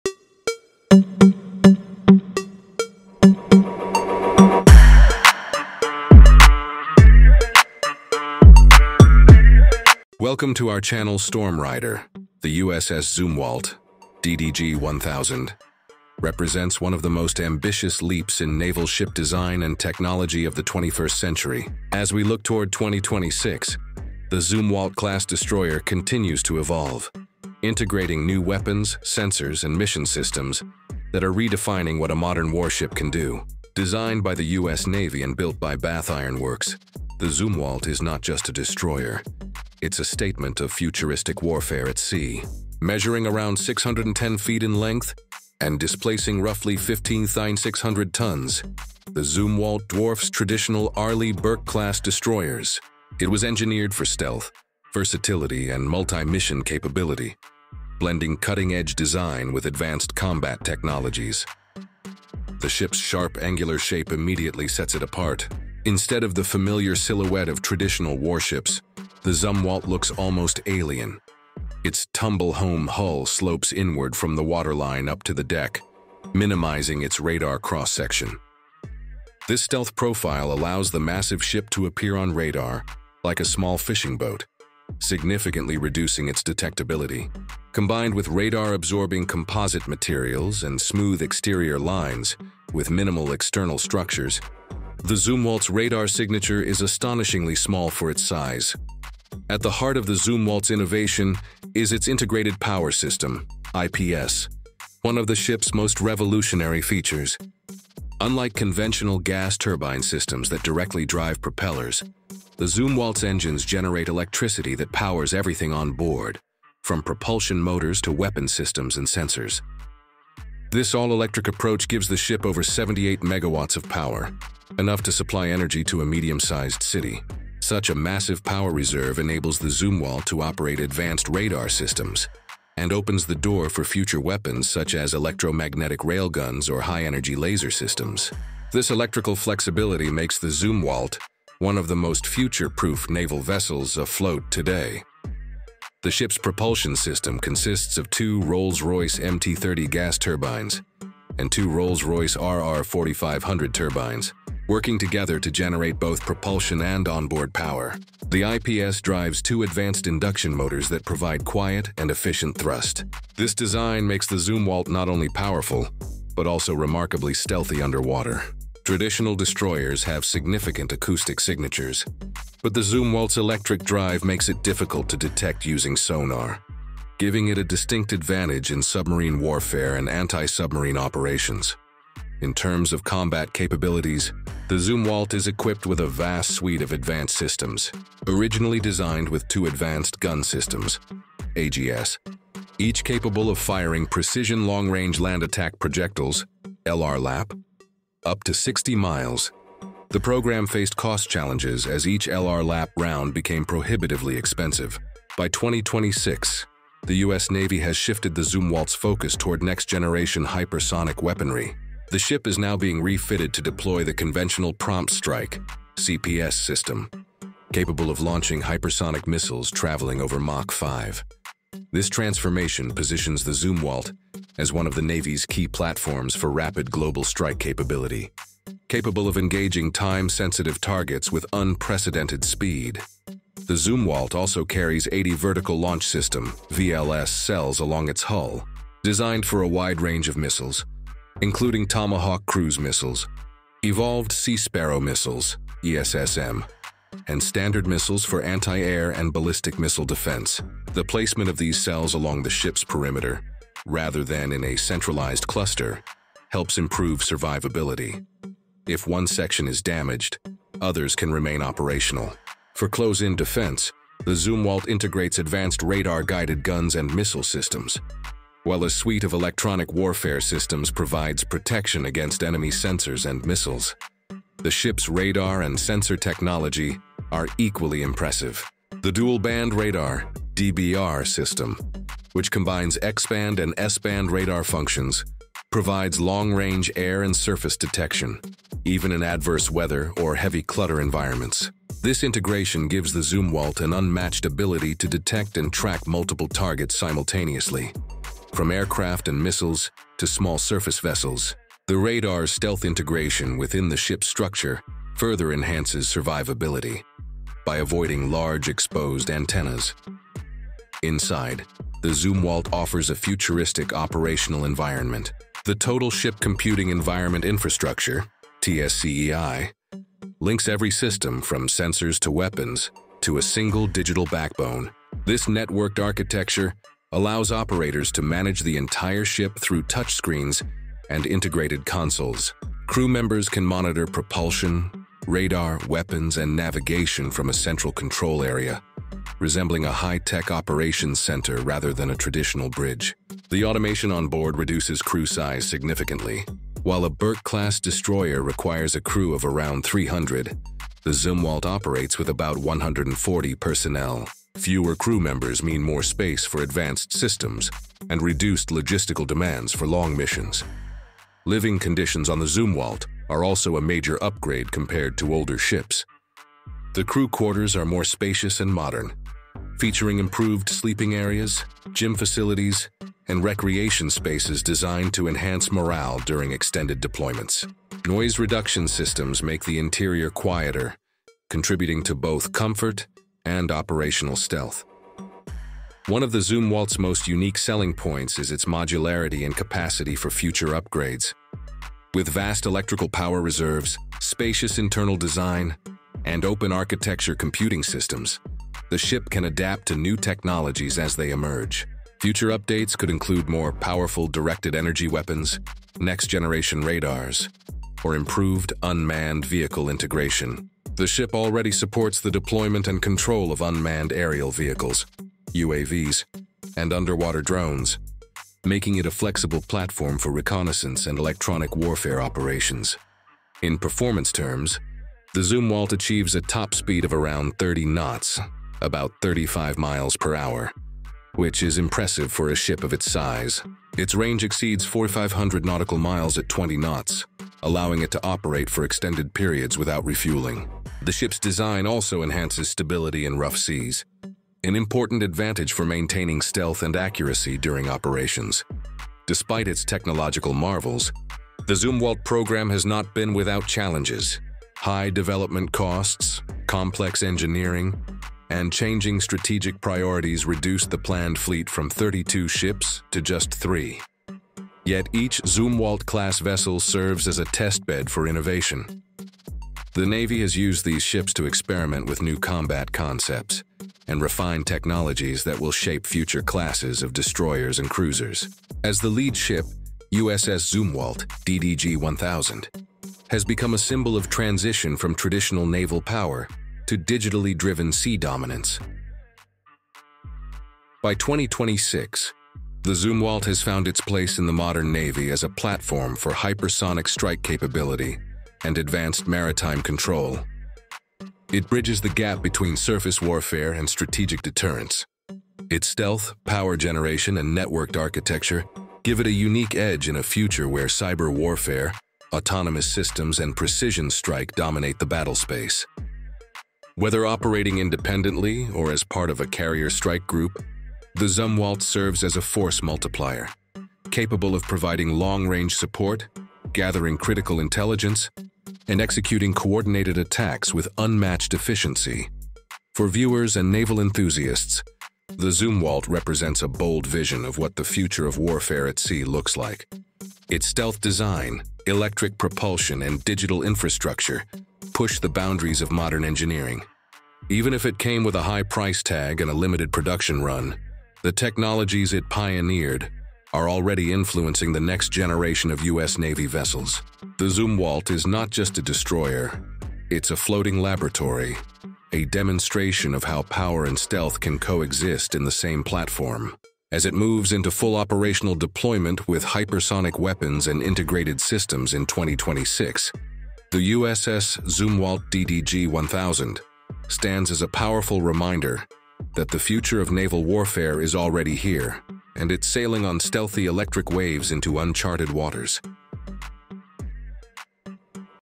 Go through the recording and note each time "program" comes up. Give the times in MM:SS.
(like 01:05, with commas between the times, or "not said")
03:20, 07:32.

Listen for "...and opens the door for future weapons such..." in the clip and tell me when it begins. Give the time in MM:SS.
02:12.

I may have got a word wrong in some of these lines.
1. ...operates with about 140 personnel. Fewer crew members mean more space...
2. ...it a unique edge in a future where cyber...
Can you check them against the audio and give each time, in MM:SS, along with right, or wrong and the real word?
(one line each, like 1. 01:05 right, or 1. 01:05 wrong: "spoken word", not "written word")
1. 05:51 right
2. 08:29 right.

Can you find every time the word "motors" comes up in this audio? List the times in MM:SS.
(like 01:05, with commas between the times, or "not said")
01:57, 02:40.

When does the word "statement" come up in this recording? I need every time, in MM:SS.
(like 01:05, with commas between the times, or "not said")
00:40.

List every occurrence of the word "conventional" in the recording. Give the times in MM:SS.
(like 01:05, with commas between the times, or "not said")
01:48, 03:34.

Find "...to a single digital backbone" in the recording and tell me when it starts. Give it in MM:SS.
05:23.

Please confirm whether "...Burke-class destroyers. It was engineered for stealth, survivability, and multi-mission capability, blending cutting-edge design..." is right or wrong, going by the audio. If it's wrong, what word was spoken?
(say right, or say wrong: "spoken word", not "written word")
wrong: "versatility", not "survivability".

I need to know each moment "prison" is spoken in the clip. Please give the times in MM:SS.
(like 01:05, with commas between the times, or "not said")
not said.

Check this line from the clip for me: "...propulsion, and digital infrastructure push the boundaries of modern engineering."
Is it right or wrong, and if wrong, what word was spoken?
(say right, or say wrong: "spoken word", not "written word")
right.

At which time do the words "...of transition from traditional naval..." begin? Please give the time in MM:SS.
08:04.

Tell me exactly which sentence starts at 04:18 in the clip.
If one section is damaged, others can remain operational.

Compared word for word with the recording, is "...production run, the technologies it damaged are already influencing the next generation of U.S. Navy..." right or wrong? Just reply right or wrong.
wrong.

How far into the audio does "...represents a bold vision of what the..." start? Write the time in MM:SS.
08:56.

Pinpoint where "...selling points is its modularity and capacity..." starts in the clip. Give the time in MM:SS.
06:27.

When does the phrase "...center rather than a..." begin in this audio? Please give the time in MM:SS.
05:41.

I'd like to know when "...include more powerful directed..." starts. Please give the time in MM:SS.
06:43.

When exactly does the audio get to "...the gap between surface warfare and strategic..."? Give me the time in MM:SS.
08:22.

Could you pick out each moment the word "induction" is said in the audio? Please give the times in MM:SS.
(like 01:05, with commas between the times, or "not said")
02:40.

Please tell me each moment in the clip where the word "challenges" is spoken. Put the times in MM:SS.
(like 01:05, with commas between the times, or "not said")
03:21, 07:33.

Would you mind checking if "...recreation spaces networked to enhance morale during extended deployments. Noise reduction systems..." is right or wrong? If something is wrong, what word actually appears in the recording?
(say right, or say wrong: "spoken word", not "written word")
wrong: "designed", not "networked".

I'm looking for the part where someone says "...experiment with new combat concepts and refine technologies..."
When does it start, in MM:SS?
07:51.